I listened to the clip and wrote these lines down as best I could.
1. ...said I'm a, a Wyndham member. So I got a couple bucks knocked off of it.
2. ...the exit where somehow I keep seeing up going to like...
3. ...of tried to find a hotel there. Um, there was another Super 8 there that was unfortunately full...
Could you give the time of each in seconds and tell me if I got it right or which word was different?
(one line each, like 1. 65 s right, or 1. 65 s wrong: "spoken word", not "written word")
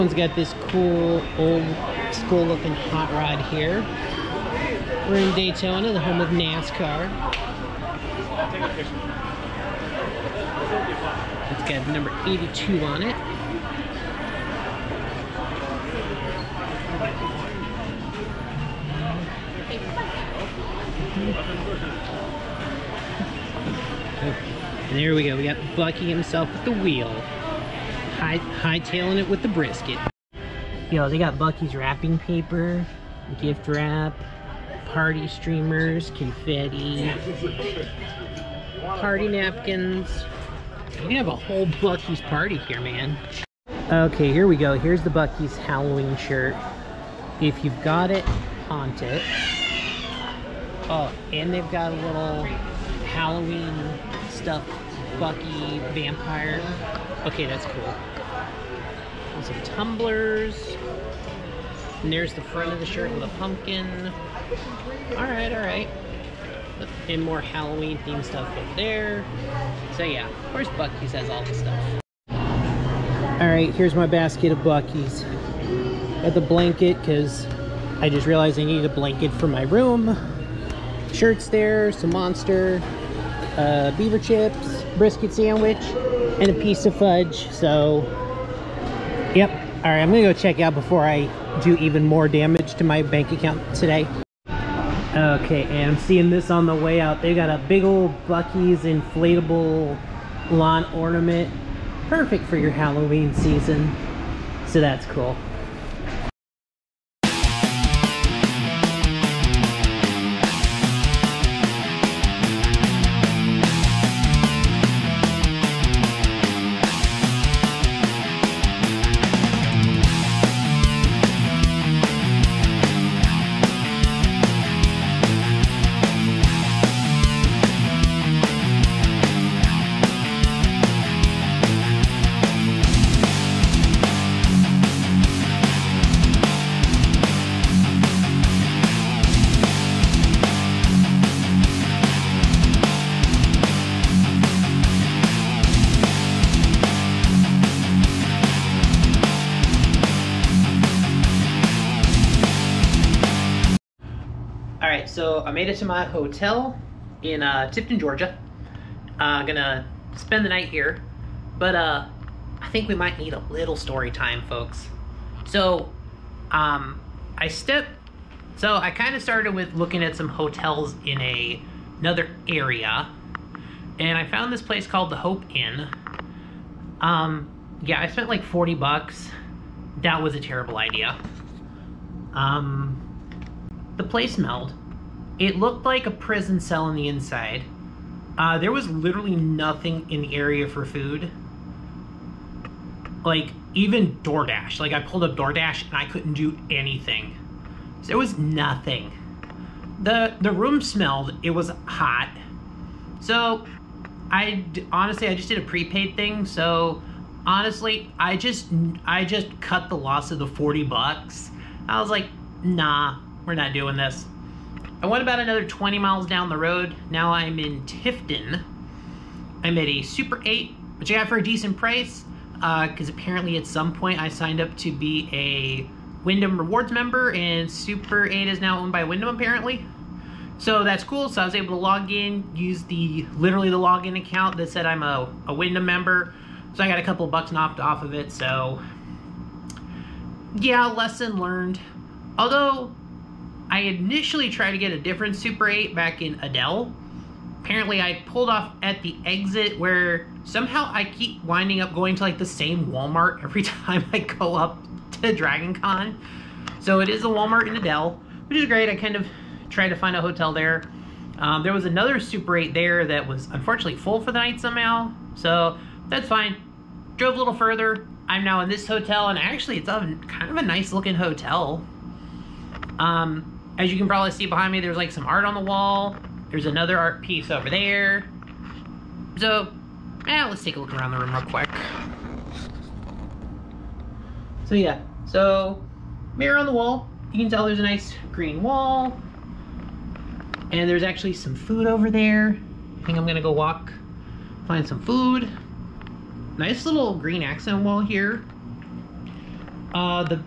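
1. 234 s right
2. 249 s wrong: "winding", not "seeing"
3. 259 s right.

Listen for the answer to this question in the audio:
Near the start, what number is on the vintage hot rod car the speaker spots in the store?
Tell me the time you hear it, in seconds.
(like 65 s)
11 s.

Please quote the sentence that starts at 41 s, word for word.
We have a whole Buc-ee's party here, man.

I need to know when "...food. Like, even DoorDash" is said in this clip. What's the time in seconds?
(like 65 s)
190 s.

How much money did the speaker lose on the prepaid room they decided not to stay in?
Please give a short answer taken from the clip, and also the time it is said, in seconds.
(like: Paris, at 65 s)
$40, at 210 s.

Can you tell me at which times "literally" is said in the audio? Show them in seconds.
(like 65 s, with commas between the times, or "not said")
188 s, 233 s.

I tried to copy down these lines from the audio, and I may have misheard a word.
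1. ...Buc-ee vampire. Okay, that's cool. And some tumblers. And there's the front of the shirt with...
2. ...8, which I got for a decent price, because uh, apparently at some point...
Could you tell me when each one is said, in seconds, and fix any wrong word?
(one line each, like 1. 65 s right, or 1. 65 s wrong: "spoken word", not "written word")
1. 55 s right
2. 220 s right.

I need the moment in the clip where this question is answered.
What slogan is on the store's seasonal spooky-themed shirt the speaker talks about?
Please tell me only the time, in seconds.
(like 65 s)
47 s.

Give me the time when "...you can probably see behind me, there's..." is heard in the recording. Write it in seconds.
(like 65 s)
273 s.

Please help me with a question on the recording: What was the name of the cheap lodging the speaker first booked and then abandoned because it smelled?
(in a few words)
Hope Inn.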